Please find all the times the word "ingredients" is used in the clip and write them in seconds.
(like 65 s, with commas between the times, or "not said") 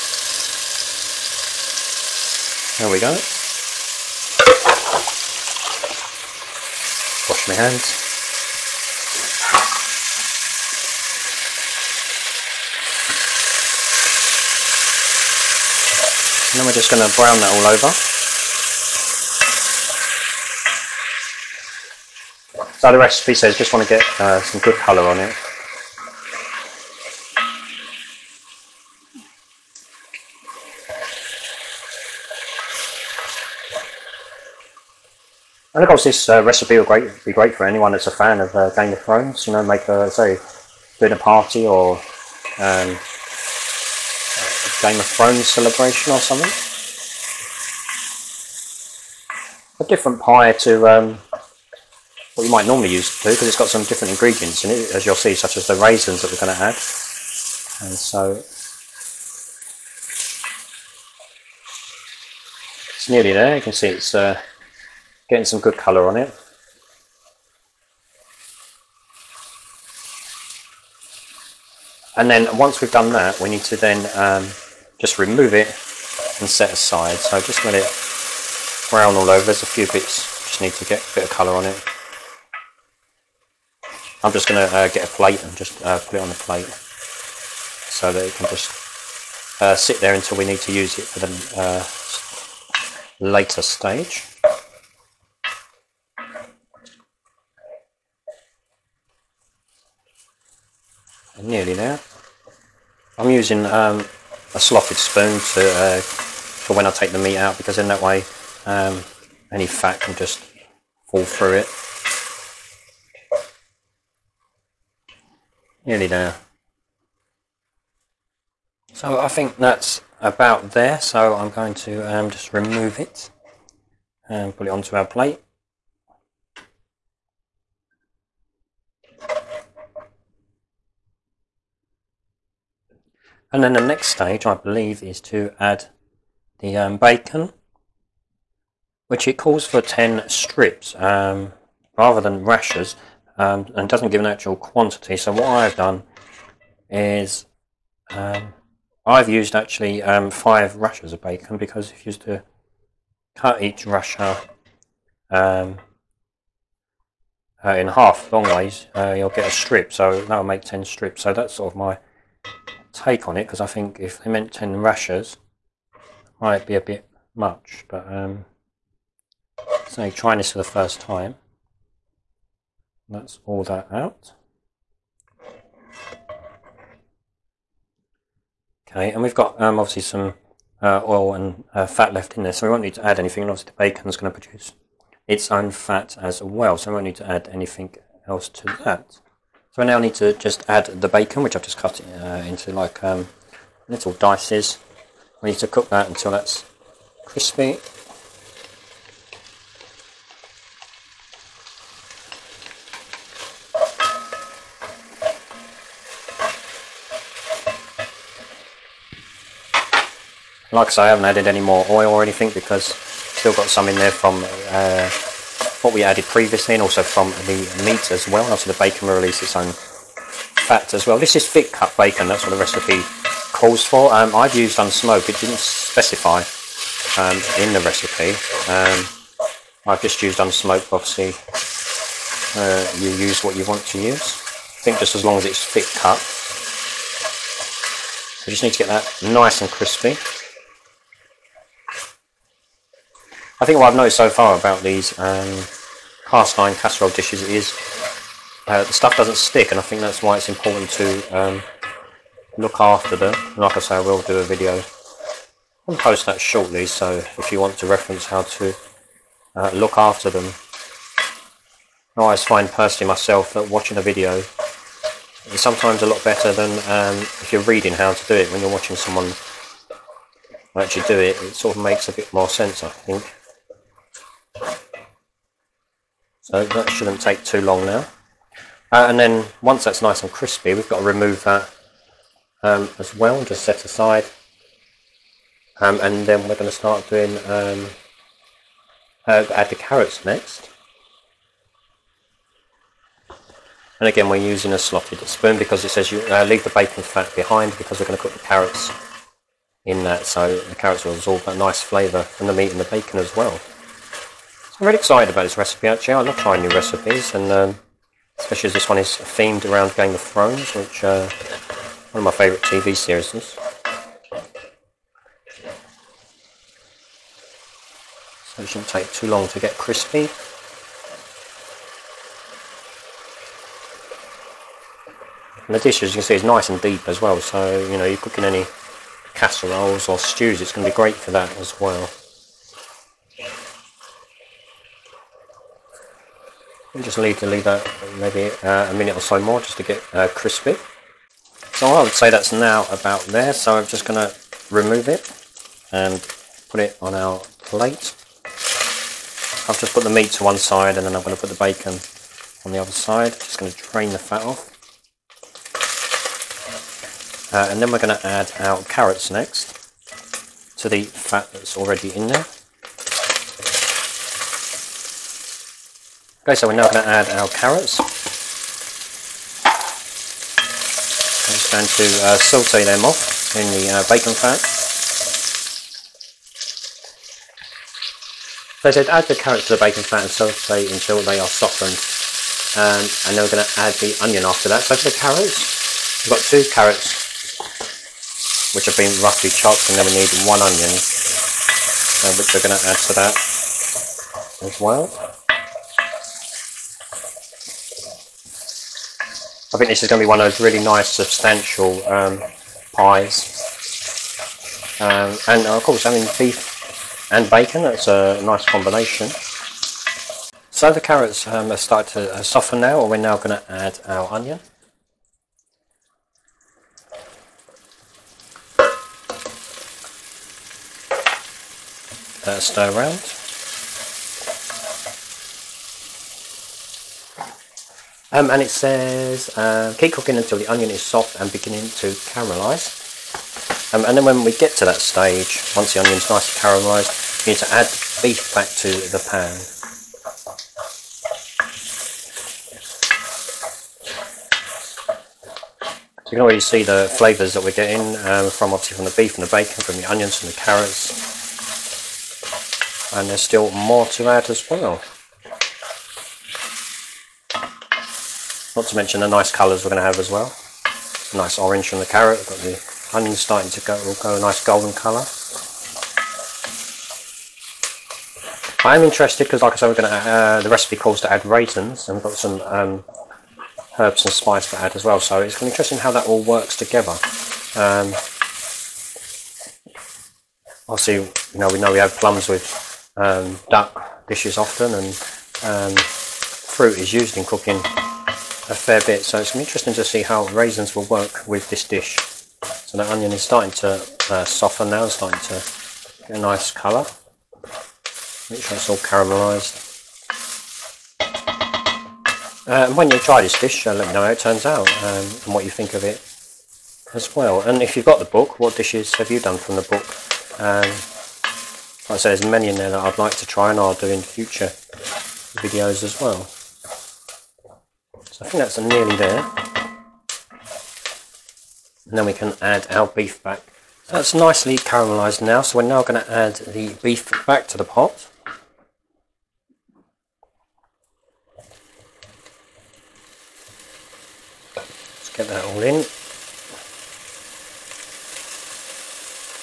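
54 s.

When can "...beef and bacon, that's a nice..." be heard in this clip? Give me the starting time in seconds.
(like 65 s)
406 s.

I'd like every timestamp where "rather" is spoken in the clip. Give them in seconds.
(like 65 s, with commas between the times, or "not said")
141 s.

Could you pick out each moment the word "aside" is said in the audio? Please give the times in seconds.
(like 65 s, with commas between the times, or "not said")
76 s, 283 s.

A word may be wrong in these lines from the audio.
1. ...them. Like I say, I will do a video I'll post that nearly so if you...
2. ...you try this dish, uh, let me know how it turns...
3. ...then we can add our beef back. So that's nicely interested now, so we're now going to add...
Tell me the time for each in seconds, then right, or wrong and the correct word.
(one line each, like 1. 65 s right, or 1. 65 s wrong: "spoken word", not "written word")
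1. 253 s wrong: "shortly", not "nearly"
2. 503 s right
3. 522 s wrong: "caramelised", not "interested".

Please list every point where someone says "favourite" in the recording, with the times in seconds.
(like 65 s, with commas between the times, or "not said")
312 s.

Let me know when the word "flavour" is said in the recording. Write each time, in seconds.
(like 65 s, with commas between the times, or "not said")
301 s, 447 s.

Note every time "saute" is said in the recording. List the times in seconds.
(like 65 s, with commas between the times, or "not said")
372 s, 380 s.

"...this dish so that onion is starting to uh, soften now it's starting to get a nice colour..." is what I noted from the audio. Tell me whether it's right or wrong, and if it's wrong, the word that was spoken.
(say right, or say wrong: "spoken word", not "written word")
right.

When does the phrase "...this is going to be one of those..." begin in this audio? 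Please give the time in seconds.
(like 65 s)
399 s.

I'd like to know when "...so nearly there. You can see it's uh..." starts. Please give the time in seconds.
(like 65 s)
57 s.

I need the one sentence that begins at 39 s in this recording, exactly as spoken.
You know, make a say dinner party or um, a Game of Thrones celebration or something.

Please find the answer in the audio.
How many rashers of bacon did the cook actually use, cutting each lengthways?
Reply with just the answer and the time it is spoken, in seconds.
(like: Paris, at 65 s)
5, at 150 s.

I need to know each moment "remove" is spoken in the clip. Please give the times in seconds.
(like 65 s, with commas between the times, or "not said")
75 s, 122 s, 281 s, 344 s.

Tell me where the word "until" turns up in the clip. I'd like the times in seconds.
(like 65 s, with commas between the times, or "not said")
90 s, 196 s, 380 s, 430 s.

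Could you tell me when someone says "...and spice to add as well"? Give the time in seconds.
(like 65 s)
474 s.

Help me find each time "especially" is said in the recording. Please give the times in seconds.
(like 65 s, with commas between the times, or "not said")
308 s.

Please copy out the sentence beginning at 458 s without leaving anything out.
Not to mention the nice colours we're going to have as well.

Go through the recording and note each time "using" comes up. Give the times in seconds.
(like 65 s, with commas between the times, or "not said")
103 s, 294 s.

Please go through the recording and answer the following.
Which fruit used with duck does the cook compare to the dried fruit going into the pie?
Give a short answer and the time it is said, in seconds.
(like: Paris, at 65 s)
Plums, at 482 s.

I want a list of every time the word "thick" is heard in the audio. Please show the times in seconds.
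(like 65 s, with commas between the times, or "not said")
221 s, 235 s.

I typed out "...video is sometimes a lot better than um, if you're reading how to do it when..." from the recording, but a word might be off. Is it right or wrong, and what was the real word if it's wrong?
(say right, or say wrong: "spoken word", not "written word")
right.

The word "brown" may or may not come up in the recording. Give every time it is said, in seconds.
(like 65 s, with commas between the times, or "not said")
17 s, 78 s.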